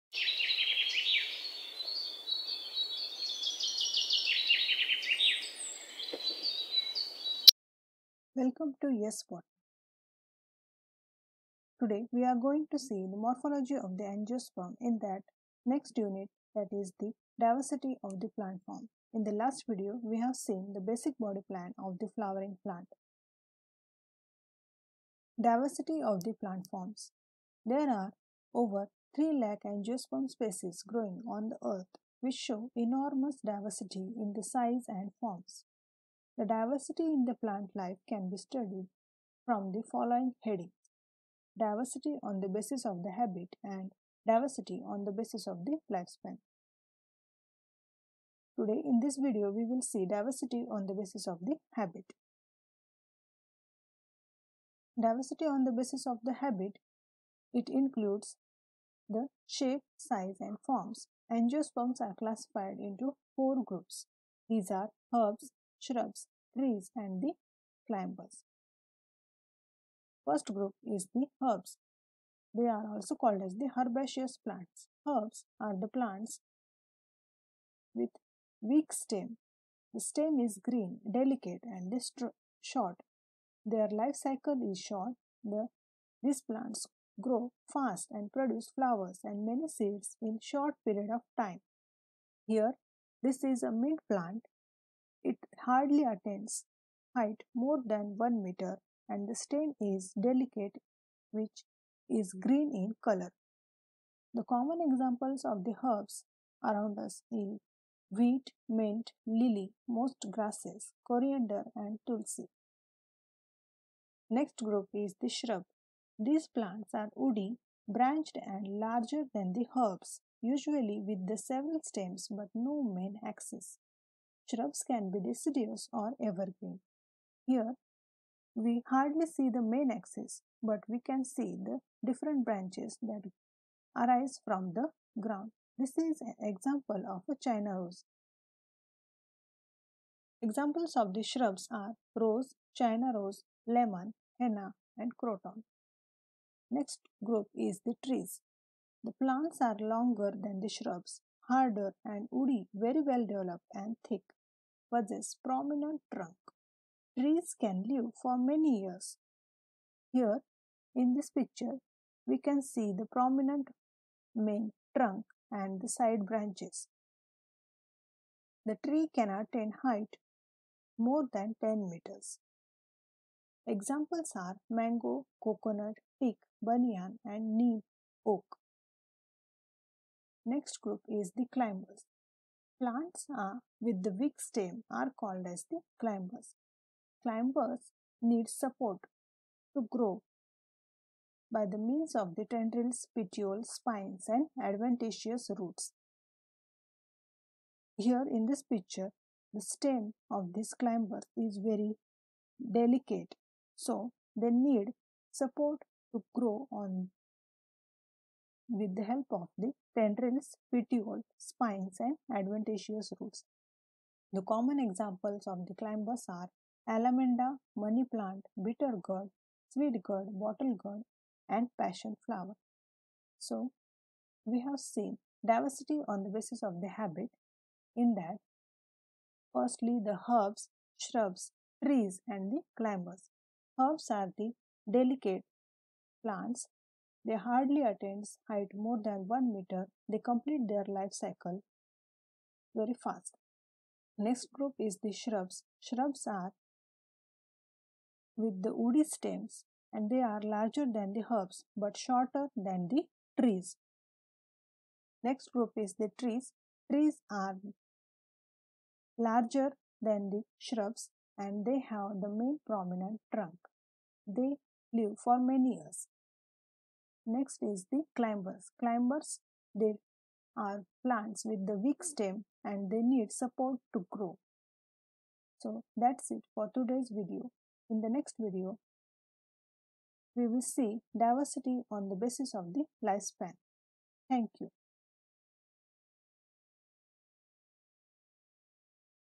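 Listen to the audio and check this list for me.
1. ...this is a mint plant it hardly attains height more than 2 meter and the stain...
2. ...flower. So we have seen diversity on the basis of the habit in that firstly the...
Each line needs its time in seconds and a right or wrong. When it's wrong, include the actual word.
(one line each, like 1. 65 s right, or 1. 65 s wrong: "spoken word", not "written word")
1. 93 s wrong: "1", not "2"
2. 222 s right.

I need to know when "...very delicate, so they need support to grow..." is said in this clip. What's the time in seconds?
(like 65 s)
201 s.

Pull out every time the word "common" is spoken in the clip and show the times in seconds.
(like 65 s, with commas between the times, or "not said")
104 s, 214 s.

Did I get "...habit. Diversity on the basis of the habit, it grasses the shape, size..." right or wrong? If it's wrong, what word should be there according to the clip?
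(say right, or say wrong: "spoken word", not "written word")
wrong: "includes", not "grasses".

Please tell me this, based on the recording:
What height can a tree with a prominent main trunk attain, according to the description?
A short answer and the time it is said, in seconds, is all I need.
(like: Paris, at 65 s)
More than 10 meters, at 170 s.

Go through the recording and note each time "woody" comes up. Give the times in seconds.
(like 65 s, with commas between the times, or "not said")
117 s, 152 s, 248 s.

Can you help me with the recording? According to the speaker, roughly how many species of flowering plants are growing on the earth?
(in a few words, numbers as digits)
Over 3 lakh.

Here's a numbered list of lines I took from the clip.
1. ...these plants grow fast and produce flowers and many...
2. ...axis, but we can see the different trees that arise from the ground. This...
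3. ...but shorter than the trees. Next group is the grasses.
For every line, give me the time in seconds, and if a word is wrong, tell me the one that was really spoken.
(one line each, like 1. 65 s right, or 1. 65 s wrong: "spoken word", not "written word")
1. 86 s right
2. 129 s wrong: "branches", not "trees"
3. 251 s wrong: "trees", not "grasses".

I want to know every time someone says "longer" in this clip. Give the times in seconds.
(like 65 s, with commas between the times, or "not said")
149 s.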